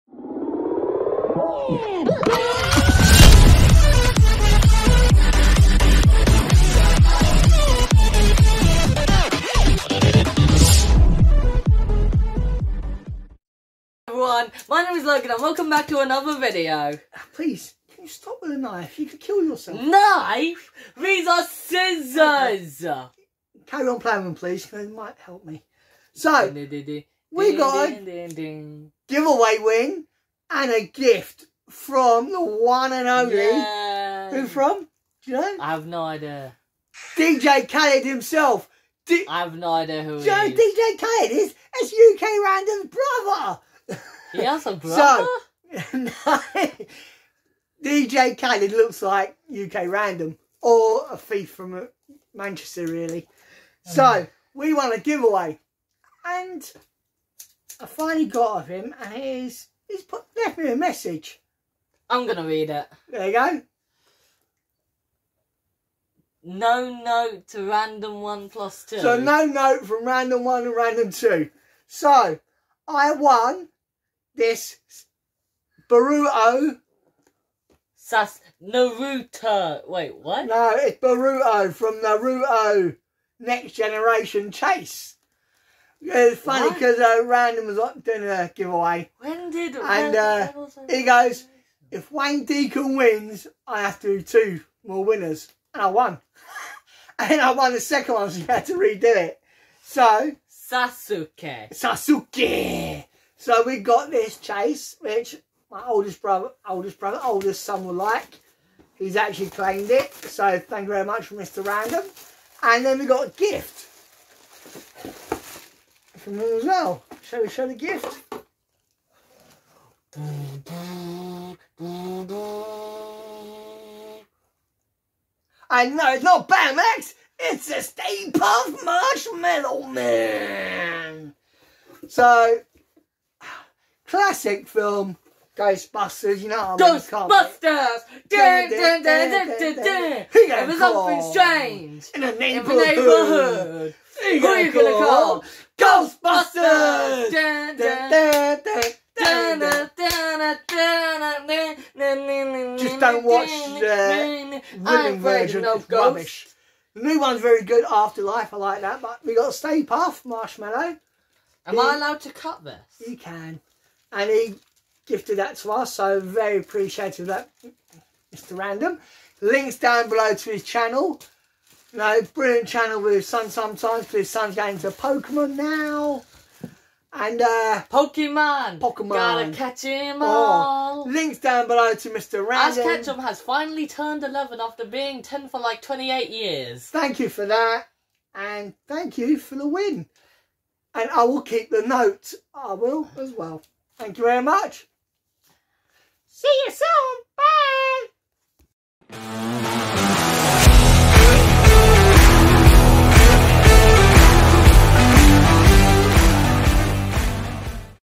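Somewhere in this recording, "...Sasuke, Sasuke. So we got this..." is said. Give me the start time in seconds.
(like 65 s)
100 s.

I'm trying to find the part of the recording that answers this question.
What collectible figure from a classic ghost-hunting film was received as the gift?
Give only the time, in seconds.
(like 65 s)
127 s.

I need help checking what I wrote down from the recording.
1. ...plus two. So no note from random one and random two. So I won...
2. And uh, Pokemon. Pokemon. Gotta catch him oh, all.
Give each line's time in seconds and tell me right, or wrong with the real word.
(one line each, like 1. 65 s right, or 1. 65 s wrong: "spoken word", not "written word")
1. 68 s right
2. 177 s right.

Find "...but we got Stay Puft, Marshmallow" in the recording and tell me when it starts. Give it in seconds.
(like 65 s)
159 s.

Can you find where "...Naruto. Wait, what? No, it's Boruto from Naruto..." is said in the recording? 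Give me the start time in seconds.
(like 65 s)
78 s.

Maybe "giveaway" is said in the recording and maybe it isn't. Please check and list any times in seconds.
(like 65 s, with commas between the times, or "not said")
29 s, 54 s, 88 s.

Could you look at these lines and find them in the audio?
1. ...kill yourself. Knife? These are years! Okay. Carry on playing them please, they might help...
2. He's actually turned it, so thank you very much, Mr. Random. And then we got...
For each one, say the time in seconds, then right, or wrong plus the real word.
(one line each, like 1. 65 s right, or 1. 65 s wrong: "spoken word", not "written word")
1. 19 s wrong: "scissors", not "years"
2. 108 s wrong: "claimed", not "turned".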